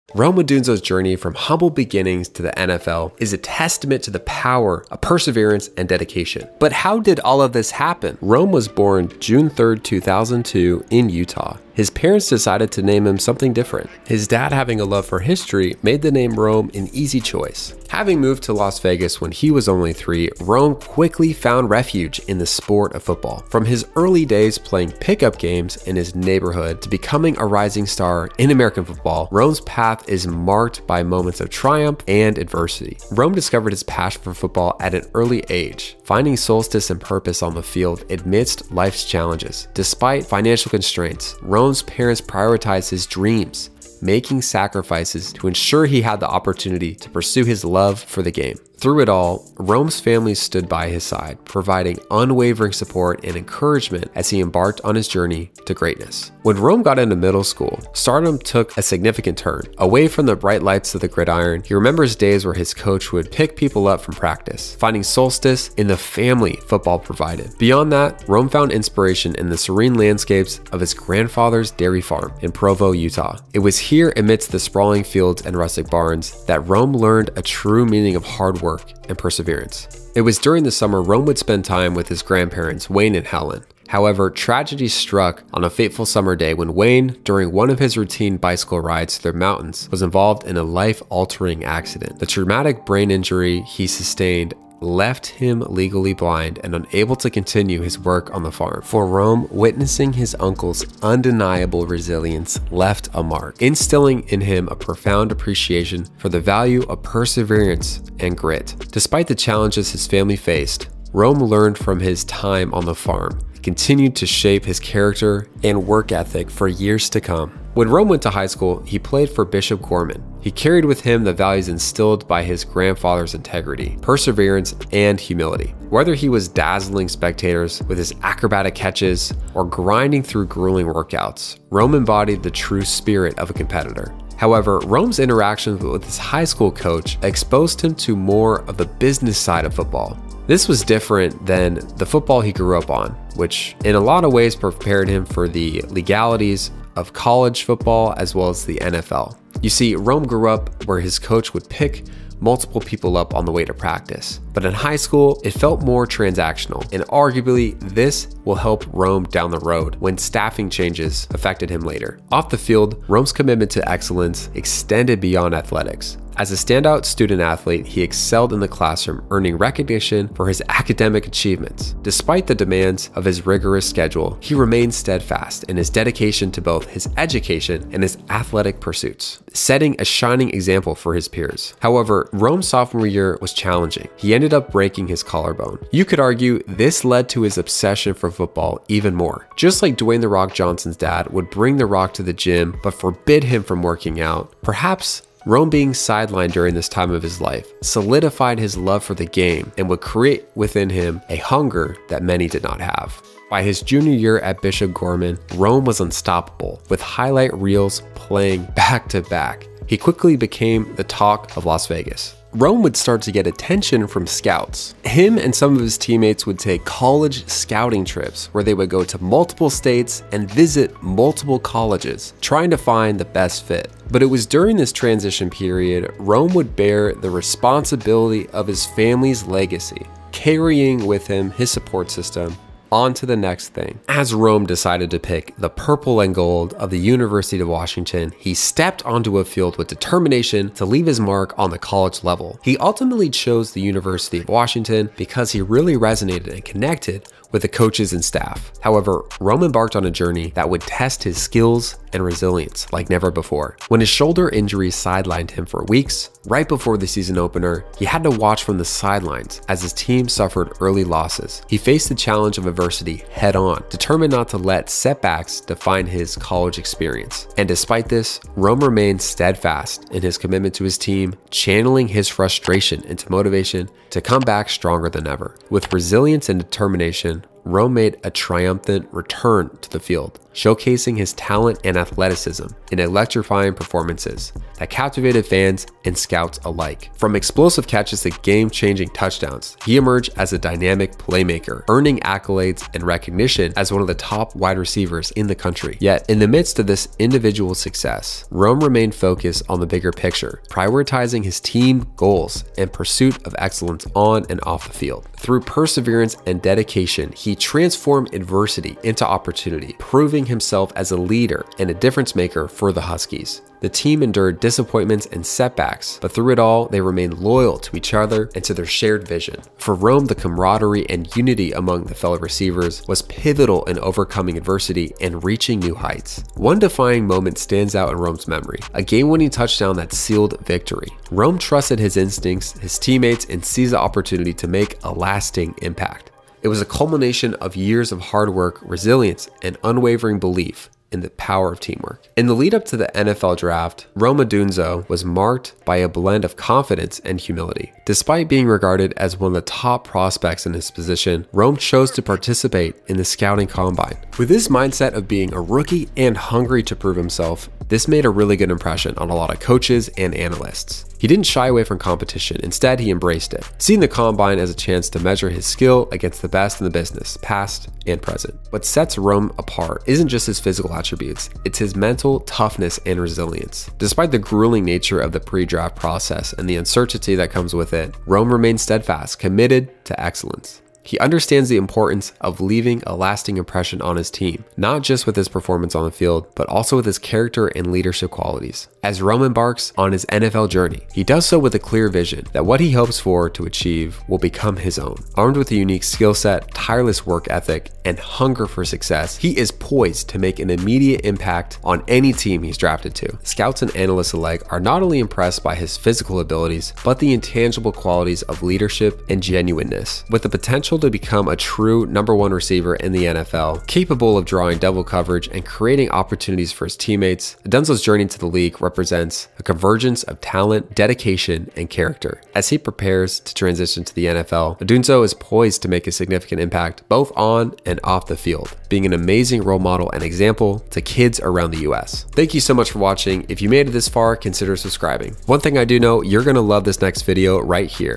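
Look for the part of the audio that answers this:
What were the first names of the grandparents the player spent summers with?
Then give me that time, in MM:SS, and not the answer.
01:22.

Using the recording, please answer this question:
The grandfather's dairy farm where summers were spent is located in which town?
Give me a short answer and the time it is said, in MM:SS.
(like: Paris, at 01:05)
Provo, at 01:12.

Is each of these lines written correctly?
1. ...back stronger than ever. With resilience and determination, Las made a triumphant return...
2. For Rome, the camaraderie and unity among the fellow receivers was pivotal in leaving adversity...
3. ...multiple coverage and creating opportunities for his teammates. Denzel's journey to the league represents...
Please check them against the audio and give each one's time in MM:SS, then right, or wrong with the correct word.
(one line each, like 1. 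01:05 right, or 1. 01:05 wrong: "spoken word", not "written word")
1. 04:34 wrong: "Rome", not "Las"
2. 05:19 wrong: "overcoming", not "leaving"
3. 06:54 wrong: "double", not "multiple".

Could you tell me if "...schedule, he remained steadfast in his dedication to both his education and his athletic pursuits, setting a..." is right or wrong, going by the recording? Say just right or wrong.
right.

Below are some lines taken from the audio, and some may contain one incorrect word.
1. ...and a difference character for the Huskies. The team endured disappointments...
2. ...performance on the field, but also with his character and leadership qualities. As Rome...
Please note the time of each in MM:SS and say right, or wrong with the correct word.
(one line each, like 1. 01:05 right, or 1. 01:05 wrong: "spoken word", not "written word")
1. 05:11 wrong: "maker", not "character"
2. 06:25 right.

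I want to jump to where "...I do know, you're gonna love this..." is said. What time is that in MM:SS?
07:15.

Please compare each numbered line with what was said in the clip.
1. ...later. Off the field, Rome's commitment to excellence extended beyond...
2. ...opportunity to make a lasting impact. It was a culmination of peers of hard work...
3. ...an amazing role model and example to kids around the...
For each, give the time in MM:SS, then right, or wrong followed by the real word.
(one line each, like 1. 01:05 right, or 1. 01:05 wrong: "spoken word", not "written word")
1. 02:41 right
2. 05:33 wrong: "years", not "peers"
3. 07:09 right.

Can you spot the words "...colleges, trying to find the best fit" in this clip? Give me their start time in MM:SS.
03:41.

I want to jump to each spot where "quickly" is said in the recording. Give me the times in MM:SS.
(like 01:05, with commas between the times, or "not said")
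00:20, 03:29.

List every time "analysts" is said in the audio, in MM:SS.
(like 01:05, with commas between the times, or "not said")
06:00, 06:43.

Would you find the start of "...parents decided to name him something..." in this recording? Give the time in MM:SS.
00:11.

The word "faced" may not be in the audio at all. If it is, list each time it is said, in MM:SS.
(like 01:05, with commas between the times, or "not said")
01:50, 04:21.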